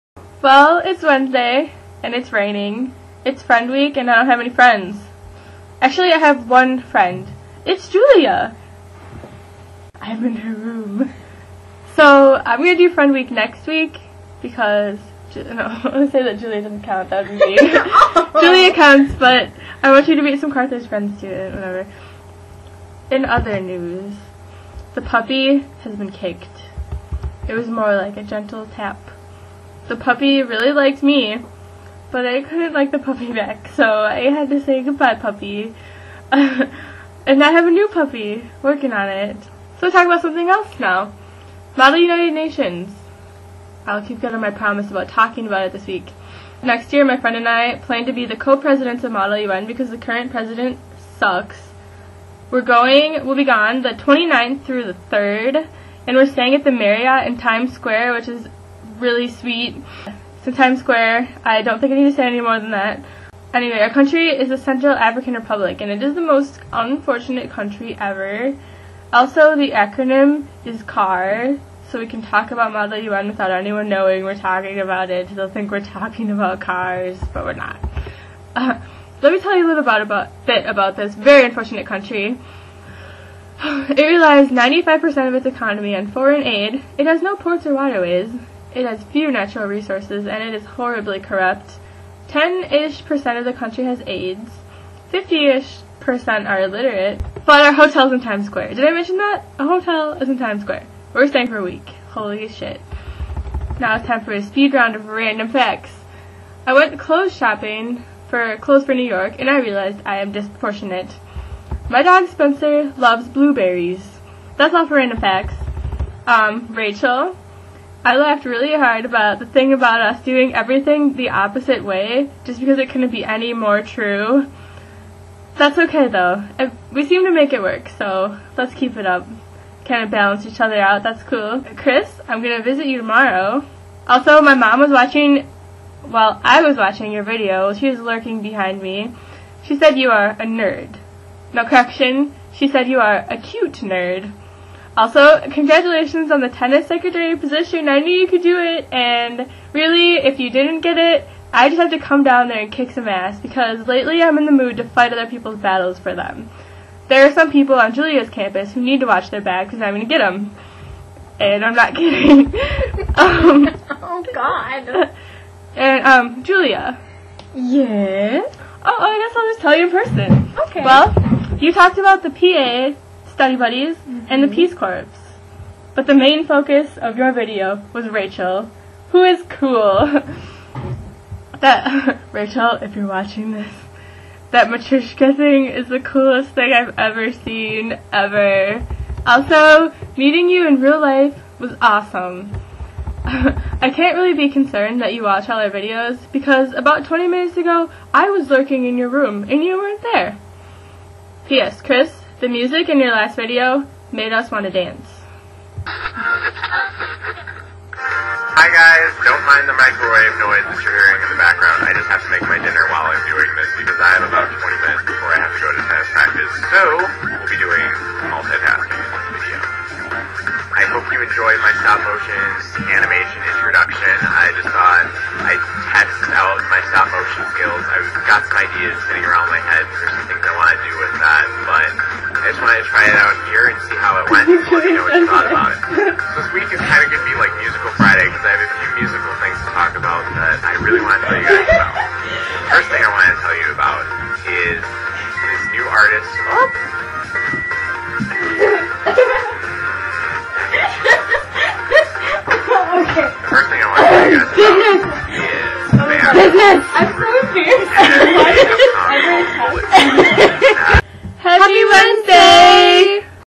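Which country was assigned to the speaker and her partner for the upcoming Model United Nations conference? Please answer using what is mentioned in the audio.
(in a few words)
Central African Republic.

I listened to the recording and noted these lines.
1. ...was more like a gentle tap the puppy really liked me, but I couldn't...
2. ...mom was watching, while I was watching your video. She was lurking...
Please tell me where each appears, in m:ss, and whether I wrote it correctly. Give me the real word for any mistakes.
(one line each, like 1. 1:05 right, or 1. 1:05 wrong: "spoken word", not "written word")
1. 0:27 right
2. 2:14 right.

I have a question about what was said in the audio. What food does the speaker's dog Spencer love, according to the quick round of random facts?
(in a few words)
Blueberries.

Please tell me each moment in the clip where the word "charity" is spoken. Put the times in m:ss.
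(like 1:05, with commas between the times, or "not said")
not said.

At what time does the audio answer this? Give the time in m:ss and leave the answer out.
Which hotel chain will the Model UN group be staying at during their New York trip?
0:56.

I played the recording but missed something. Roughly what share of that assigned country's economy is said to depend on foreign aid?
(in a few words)
95%.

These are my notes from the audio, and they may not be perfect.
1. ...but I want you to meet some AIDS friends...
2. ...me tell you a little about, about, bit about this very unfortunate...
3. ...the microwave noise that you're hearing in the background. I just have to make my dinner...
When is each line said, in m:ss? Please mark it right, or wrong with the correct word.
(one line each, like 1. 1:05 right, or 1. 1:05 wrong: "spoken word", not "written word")
1. 0:19 wrong: "Carthage", not "AIDS"
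2. 1:19 right
3. 3:29 right.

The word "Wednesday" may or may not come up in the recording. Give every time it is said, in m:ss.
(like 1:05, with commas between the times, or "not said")
0:01, 4:21.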